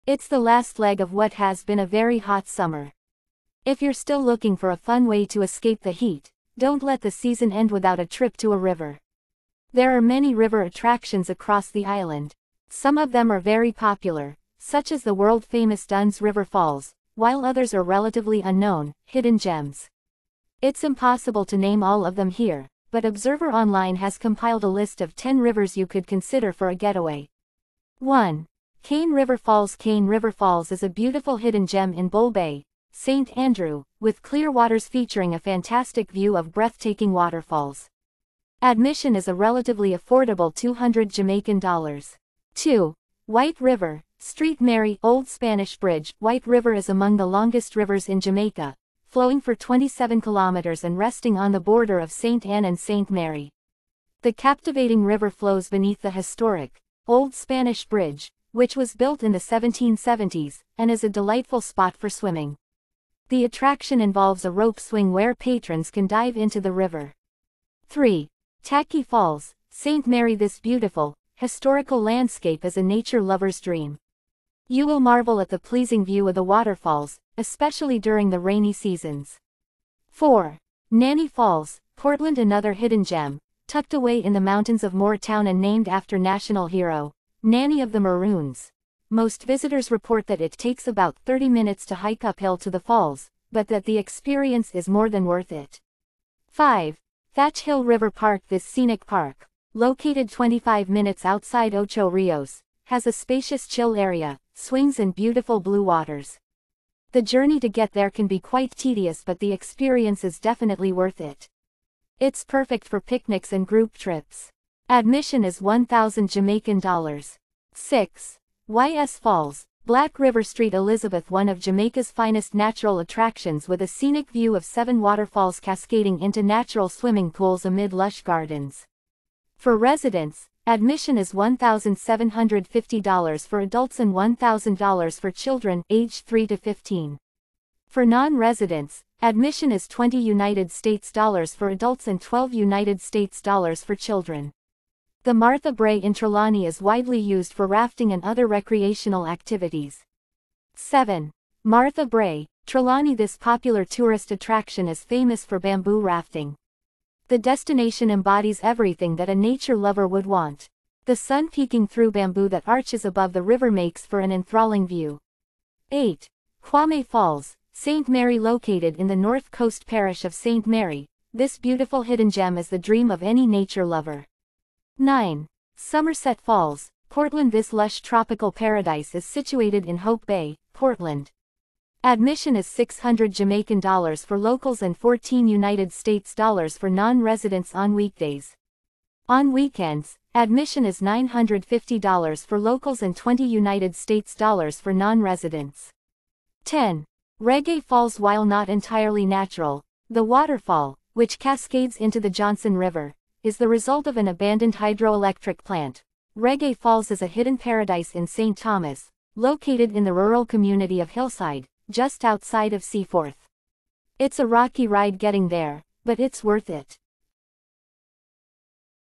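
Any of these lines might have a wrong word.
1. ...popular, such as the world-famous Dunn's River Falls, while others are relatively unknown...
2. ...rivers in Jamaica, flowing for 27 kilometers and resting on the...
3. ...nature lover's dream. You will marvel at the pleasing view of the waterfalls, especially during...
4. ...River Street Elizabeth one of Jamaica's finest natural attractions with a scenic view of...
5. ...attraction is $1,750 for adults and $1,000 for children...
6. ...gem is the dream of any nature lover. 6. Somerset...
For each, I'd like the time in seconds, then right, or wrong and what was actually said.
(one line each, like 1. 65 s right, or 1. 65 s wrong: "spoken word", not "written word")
1. 13 s right
2. 47 s right
3. 72 s right
4. 120 s right
5. 130 s wrong: "admission", not "attraction"
6. 172 s wrong: "9", not "6".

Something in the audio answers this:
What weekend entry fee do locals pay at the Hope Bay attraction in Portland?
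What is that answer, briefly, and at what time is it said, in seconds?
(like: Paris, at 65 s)
$950, at 190 s.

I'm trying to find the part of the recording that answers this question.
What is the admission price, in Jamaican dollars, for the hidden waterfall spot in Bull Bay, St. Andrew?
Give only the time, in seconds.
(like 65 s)
40 s.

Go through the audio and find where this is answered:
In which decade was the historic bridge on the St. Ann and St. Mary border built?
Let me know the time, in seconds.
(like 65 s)
59 s.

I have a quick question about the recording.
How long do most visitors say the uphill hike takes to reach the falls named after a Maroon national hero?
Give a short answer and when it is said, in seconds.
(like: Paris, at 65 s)
30 minutes, at 91 s.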